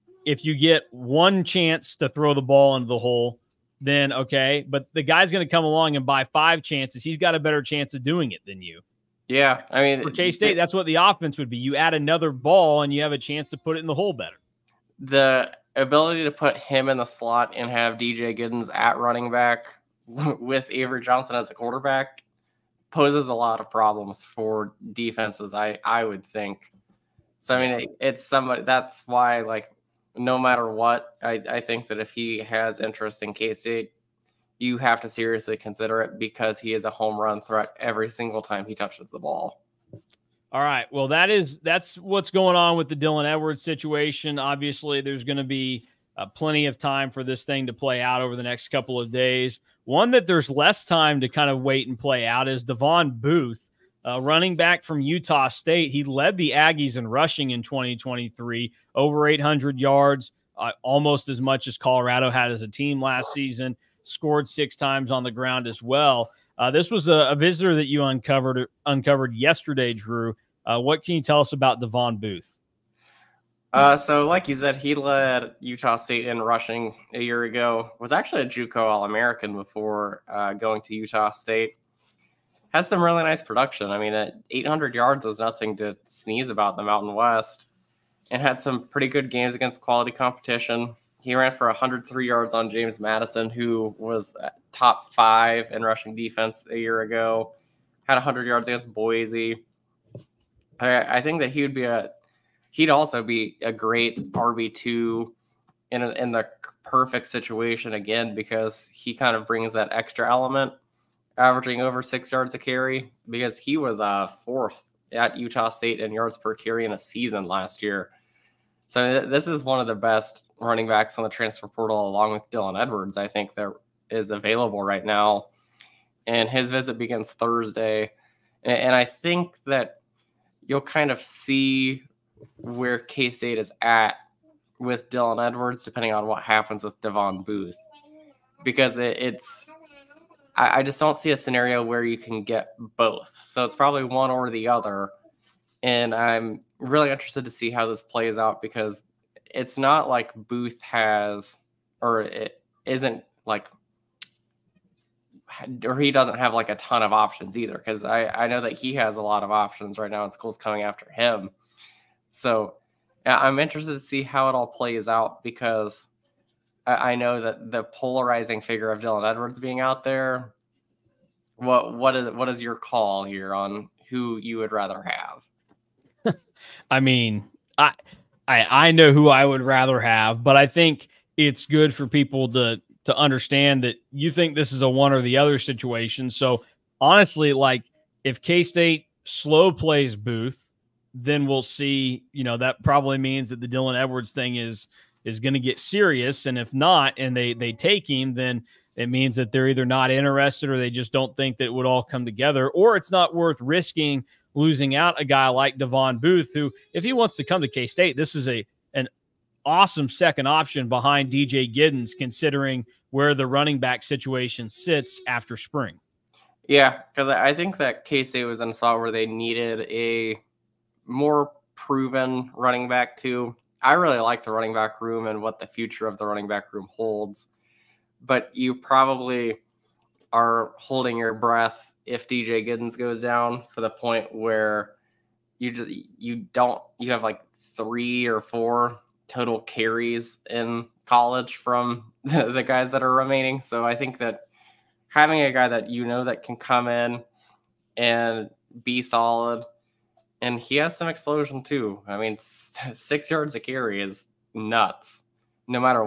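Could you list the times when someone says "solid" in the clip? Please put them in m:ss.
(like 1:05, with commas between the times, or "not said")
4:09.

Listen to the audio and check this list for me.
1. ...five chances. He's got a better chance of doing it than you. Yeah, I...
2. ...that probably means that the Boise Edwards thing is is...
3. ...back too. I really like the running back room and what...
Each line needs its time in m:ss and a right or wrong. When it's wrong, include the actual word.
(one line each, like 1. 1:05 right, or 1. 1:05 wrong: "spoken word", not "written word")
1. 0:06 right
2. 3:12 wrong: "Dylan", not "Boise"
3. 3:42 right.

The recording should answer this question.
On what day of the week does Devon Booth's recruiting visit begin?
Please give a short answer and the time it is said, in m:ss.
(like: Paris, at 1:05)
Thursday, at 2:07.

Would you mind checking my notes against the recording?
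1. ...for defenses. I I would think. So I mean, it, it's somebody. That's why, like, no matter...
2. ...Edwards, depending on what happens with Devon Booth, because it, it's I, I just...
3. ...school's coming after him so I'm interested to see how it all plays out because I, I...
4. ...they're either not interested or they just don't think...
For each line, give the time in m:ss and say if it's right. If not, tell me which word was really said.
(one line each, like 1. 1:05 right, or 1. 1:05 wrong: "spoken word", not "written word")
1. 0:24 right
2. 2:15 right
3. 2:40 right
4. 3:19 right.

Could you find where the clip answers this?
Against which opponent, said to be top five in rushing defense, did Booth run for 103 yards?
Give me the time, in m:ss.
1:32.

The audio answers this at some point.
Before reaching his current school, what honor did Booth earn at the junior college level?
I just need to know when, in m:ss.
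1:18.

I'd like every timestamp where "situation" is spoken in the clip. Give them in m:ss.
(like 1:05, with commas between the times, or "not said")
0:43, 1:47, 3:05, 3:34.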